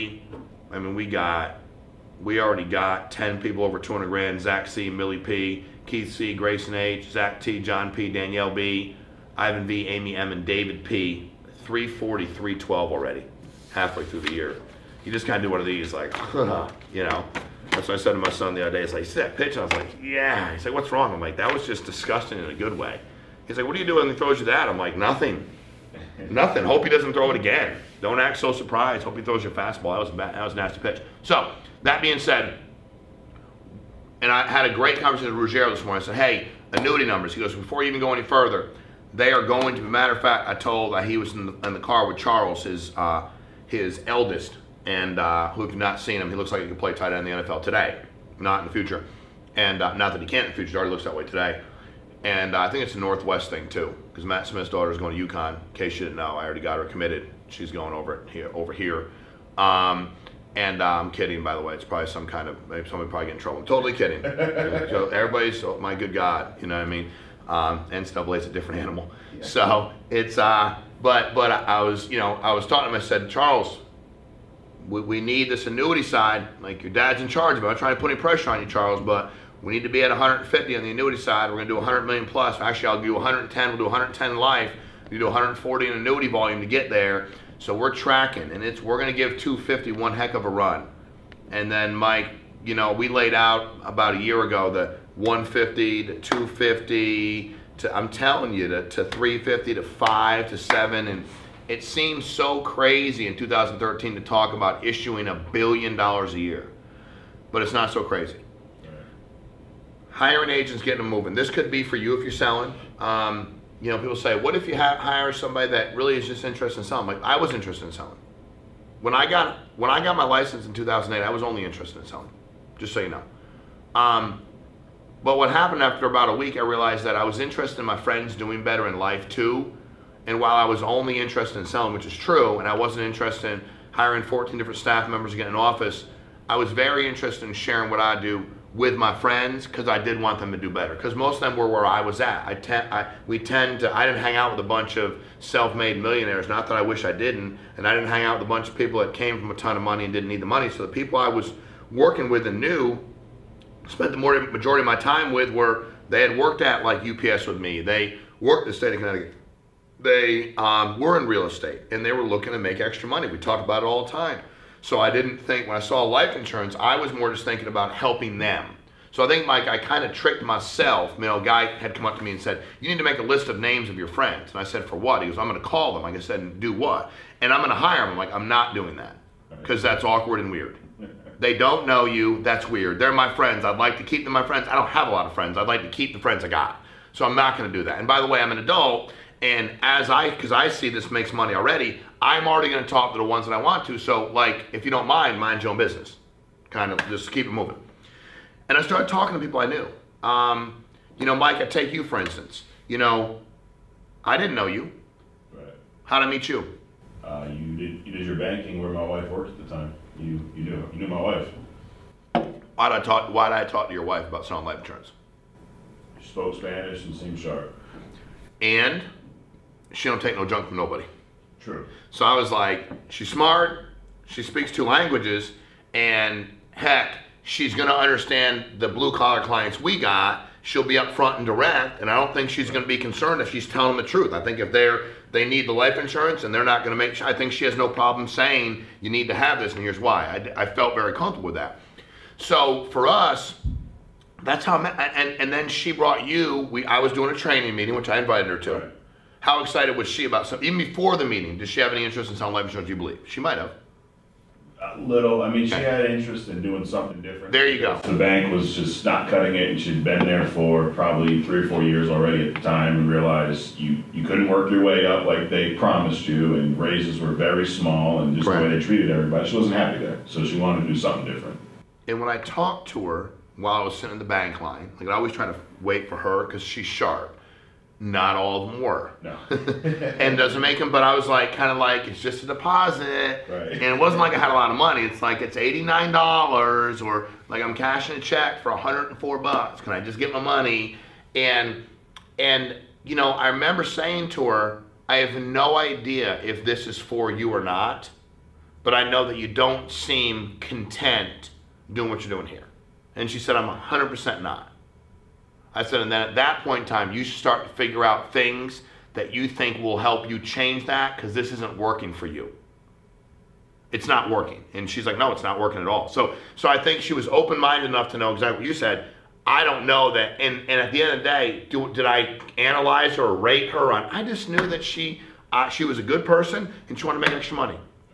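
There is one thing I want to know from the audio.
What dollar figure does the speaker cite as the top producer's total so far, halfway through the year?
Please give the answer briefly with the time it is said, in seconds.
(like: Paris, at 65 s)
340,312, at 11 s.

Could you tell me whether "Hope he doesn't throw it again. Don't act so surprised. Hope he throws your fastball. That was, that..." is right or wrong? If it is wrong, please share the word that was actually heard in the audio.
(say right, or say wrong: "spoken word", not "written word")
right.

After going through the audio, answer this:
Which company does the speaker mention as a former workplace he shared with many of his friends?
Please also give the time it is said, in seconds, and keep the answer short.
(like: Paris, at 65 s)
UPS, at 157 s.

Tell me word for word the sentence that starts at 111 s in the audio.
This could be for you if you're selling.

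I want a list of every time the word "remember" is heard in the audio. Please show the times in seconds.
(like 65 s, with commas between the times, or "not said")
293 s.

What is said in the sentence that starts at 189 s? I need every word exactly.
And as I, because I see this makes money already, I'm already going to talk to the ones that I want to.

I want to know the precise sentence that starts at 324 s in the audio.
I just knew that she, uh, she was a good person and she wanted to make extra money.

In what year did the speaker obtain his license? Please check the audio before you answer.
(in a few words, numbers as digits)
2008.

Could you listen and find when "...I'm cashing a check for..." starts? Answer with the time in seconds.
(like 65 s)
287 s.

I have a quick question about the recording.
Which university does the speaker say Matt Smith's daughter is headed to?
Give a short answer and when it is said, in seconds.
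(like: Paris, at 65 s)
UConn, at 55 s.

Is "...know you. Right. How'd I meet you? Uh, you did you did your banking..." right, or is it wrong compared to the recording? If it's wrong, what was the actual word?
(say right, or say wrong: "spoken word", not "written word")
right.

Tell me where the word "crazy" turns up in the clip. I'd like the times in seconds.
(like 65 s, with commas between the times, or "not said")
102 s, 108 s.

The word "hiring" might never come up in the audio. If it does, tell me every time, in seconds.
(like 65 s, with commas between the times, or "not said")
110 s, 133 s.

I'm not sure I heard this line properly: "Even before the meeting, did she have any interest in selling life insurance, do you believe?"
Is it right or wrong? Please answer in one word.
right.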